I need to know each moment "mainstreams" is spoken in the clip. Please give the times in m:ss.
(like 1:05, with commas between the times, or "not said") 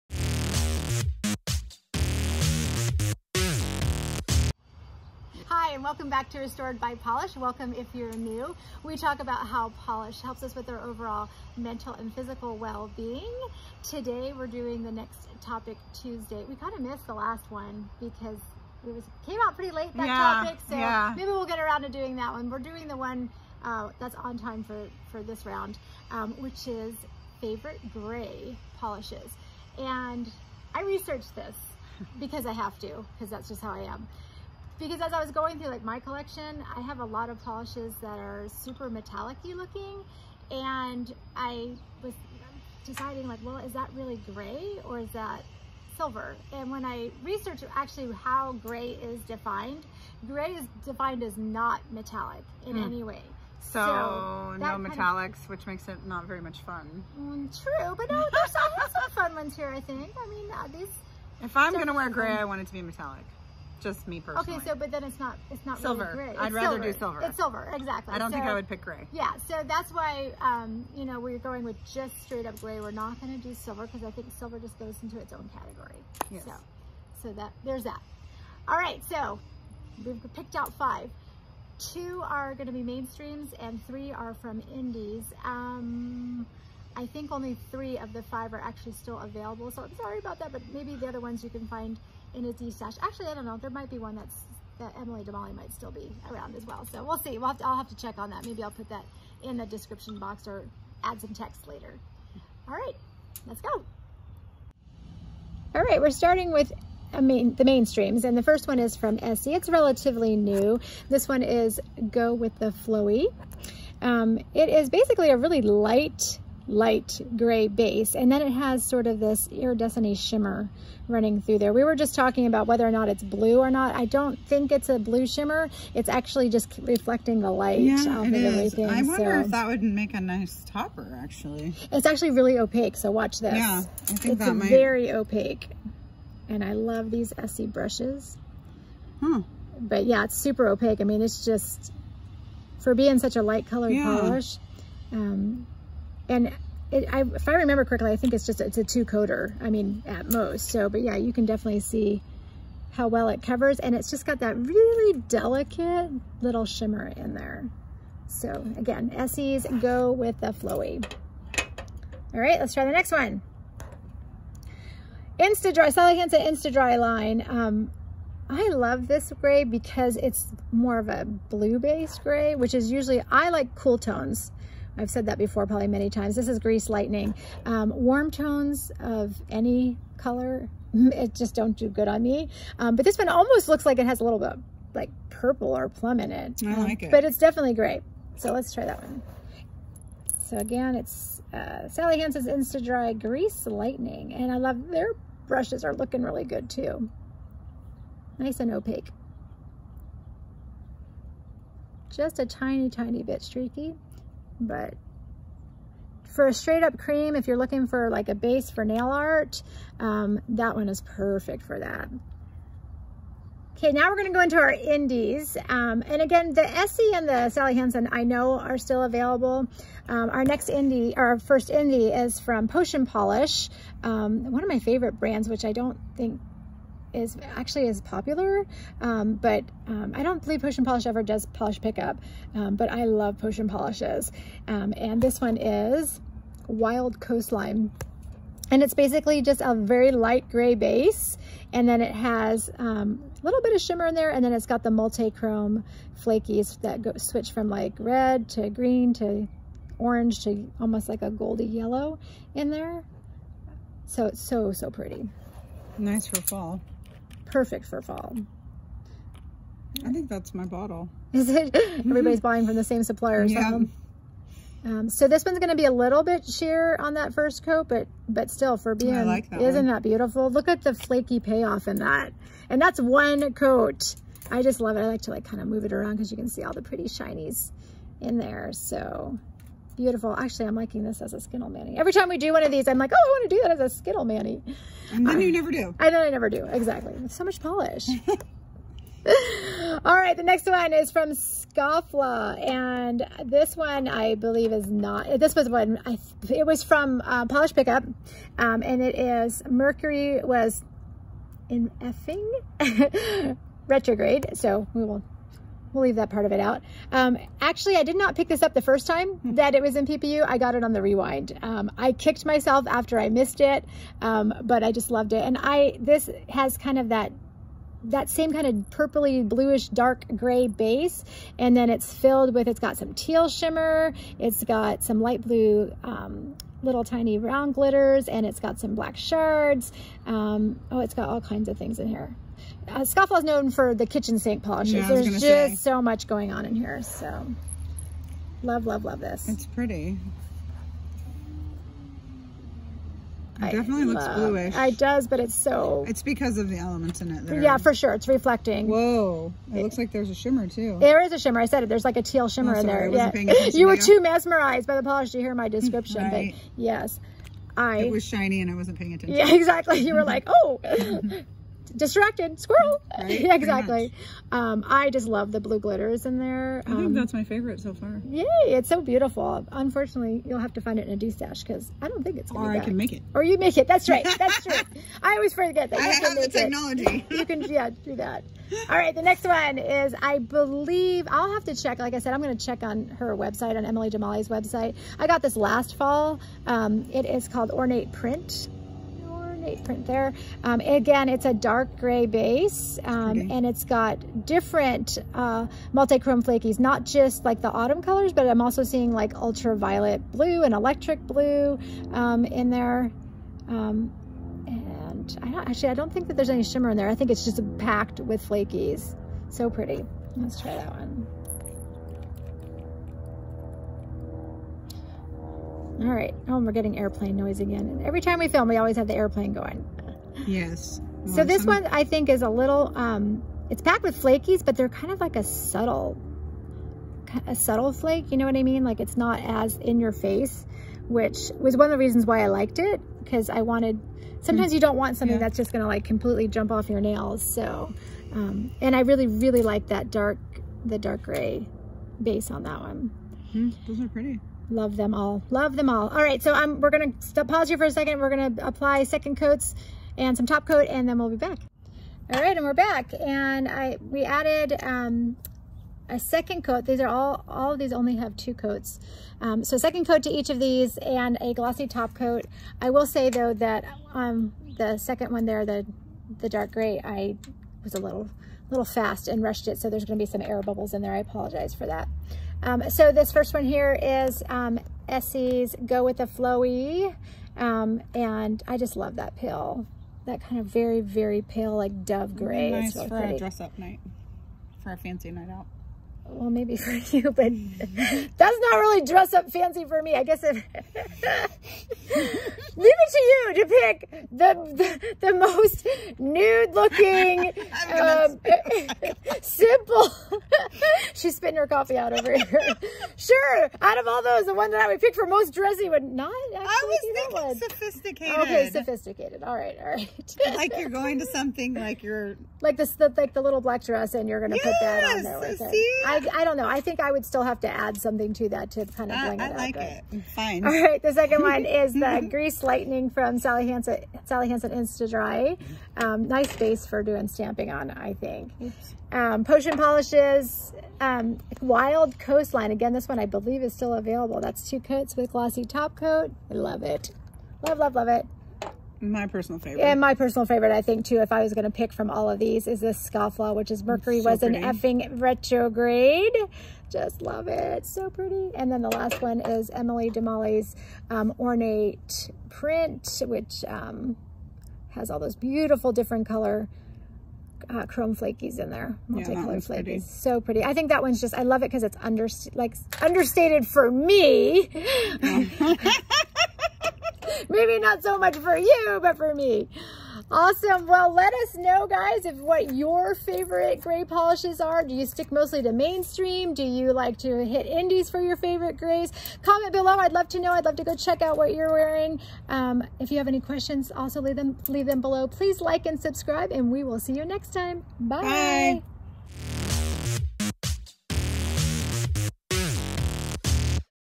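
1:22, 1:47, 9:35.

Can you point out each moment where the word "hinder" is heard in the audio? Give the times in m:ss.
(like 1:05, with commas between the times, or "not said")
not said.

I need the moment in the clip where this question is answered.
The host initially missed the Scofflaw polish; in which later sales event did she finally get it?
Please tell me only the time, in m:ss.
5:11.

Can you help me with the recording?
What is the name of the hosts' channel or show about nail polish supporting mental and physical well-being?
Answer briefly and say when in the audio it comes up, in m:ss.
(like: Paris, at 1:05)
Restored by Polish, at 0:06.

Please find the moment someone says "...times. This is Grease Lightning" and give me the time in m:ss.
2:56.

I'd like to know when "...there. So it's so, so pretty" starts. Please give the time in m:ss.
4:12.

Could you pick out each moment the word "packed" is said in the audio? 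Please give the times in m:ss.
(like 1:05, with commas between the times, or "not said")
6:47, 7:03.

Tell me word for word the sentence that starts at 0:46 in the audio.
And when I researched actually how gray is defined, gray is defined as not metallic in mm.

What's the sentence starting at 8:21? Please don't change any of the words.
She's spitting her coffee out over here.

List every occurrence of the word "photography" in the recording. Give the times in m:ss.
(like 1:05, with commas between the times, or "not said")
not said.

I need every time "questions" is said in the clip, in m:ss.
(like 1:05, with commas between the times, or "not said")
9:43.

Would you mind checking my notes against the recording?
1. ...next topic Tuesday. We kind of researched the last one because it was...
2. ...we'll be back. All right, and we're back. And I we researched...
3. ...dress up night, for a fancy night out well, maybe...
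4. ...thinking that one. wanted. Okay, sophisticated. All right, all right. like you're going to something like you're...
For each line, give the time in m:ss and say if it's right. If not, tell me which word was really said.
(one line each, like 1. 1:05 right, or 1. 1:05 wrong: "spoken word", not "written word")
1. 0:14 wrong: "missed", not "researched"
2. 7:31 wrong: "added", not "researched"
3. 8:03 right
4. 8:27 wrong: "sophisticated", not "wanted".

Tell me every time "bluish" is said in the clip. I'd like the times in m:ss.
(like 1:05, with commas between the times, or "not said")
5:19, 5:44.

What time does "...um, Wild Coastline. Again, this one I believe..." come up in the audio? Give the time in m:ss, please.
8:50.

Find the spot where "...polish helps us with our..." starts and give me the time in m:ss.
0:09.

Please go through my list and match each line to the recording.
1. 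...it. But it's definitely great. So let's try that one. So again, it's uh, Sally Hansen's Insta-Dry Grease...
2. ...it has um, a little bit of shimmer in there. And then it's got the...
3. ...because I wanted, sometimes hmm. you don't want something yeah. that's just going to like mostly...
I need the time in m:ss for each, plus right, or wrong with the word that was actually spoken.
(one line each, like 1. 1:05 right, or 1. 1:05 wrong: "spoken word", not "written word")
1. 3:07 right
2. 4:02 right
3. 7:13 wrong: "completely", not "mostly".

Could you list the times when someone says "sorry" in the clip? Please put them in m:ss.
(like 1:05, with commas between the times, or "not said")
1:29, 5:52.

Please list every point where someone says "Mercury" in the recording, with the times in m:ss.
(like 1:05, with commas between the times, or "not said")
4:59, 9:03.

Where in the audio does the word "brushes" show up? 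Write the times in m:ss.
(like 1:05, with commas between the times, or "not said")
2:17, 3:15.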